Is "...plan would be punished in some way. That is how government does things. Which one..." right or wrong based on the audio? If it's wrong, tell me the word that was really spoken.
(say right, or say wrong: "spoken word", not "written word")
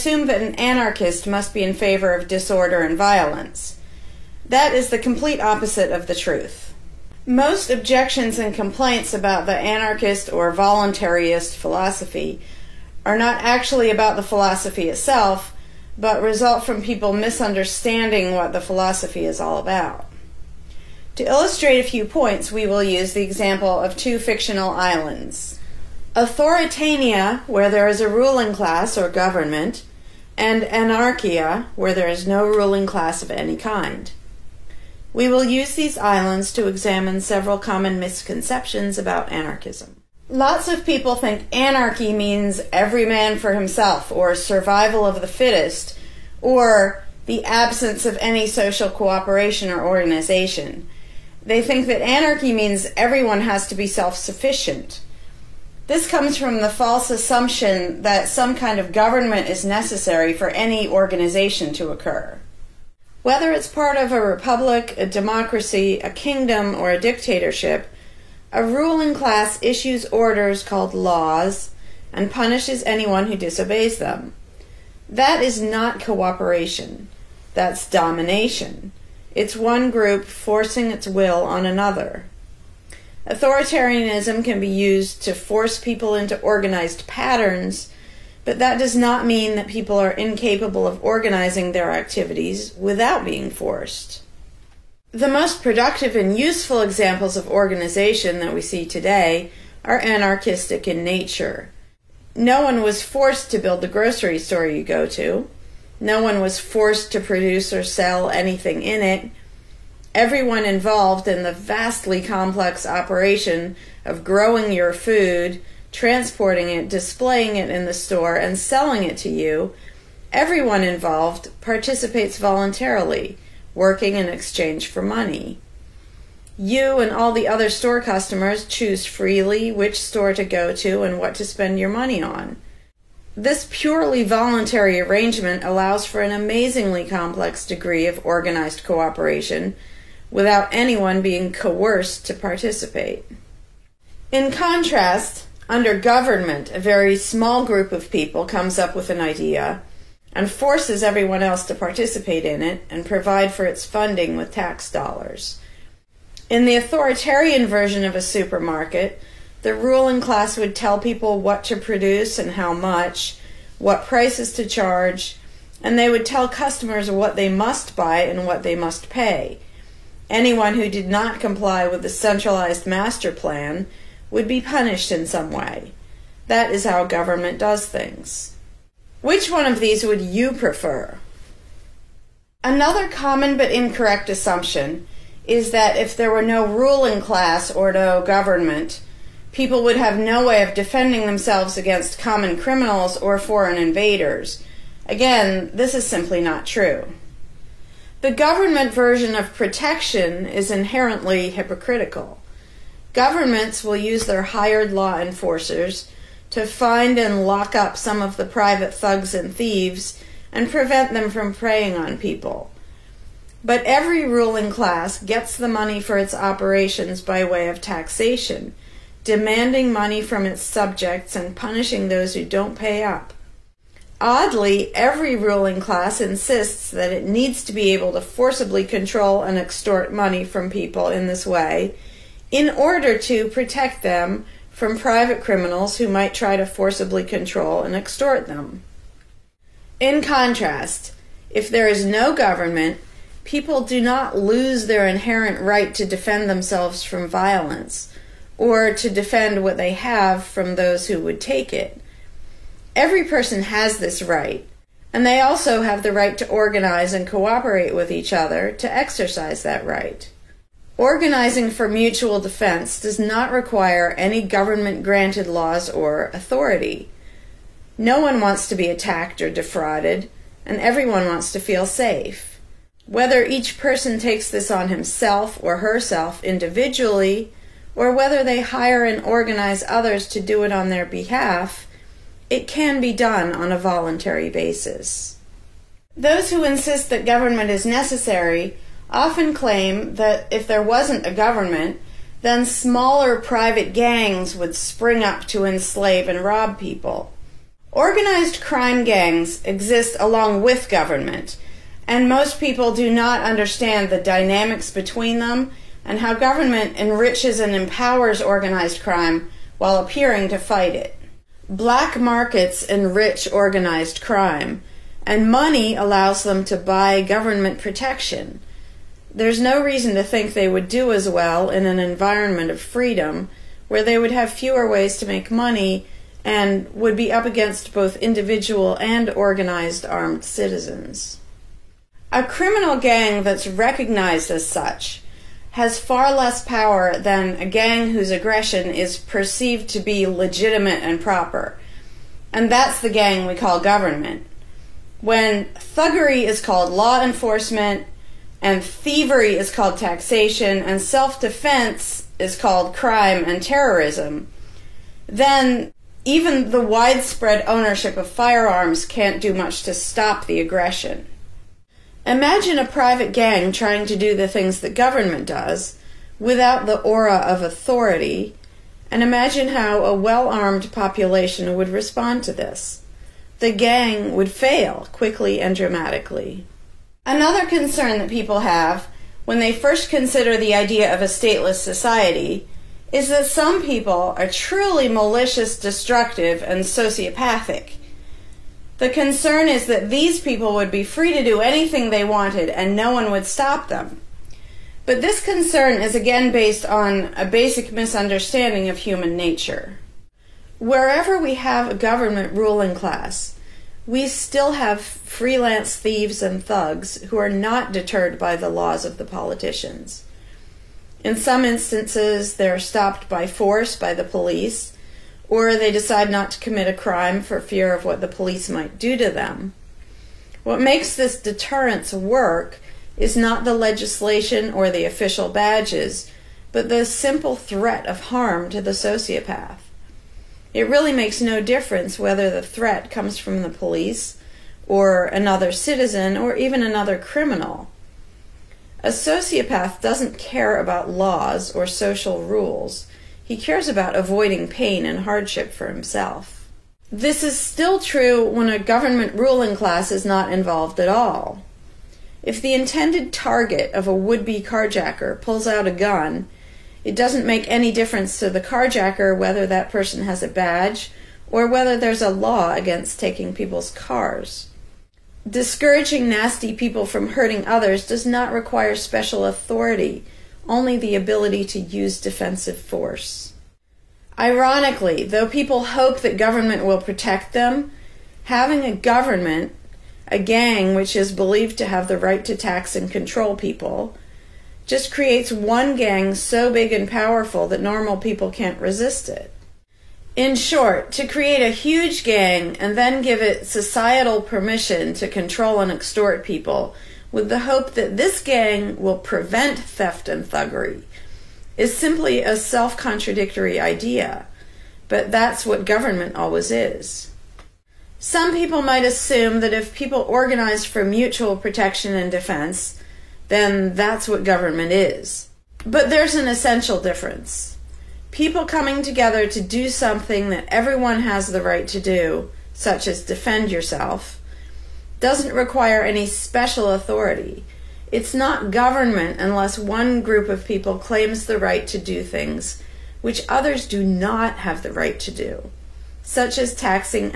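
right.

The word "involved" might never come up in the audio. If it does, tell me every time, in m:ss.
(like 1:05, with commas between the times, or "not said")
1:50, 2:00, 7:30.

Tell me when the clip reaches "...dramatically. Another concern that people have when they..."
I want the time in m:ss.
6:15.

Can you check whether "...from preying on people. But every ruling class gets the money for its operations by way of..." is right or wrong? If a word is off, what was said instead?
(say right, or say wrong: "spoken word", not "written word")
right.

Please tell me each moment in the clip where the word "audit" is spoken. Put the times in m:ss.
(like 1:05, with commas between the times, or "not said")
not said.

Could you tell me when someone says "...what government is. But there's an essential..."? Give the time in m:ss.
8:34.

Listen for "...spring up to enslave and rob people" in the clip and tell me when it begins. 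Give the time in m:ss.
4:54.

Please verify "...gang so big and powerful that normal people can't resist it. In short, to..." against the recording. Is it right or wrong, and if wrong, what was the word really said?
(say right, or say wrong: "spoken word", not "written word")
right.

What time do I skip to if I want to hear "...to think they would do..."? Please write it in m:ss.
5:20.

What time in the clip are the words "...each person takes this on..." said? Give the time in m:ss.
4:33.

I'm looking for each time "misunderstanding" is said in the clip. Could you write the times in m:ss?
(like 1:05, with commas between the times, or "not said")
0:17, 6:37.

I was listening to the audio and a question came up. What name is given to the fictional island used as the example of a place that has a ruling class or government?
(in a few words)
Authoritania.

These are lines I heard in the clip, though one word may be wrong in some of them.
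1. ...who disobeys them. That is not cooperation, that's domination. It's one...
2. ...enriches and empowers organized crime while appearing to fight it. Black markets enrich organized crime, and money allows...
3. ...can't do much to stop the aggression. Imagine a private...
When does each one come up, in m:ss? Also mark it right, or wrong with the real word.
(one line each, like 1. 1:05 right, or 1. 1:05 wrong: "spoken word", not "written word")
1. 1:13 right
2. 5:06 right
3. 5:59 right.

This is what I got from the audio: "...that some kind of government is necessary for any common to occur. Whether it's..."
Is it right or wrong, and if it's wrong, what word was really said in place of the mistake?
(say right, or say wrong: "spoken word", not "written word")
wrong: "organization", not "common".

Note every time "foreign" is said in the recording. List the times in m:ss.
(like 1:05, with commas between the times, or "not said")
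3:13.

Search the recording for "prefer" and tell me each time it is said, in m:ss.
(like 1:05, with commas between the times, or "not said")
3:00.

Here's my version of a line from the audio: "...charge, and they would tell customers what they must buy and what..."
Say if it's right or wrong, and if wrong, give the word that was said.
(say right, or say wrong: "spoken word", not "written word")
right.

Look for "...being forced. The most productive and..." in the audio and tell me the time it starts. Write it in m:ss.
1:33.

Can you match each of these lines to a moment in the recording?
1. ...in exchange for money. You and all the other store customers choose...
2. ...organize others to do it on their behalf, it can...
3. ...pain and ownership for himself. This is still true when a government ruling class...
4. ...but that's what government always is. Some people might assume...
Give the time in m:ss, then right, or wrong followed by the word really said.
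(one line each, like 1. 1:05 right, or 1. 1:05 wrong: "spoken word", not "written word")
1. 2:04 right
2. 4:39 right
3. 7:24 wrong: "hardship", not "ownership"
4. 8:25 right.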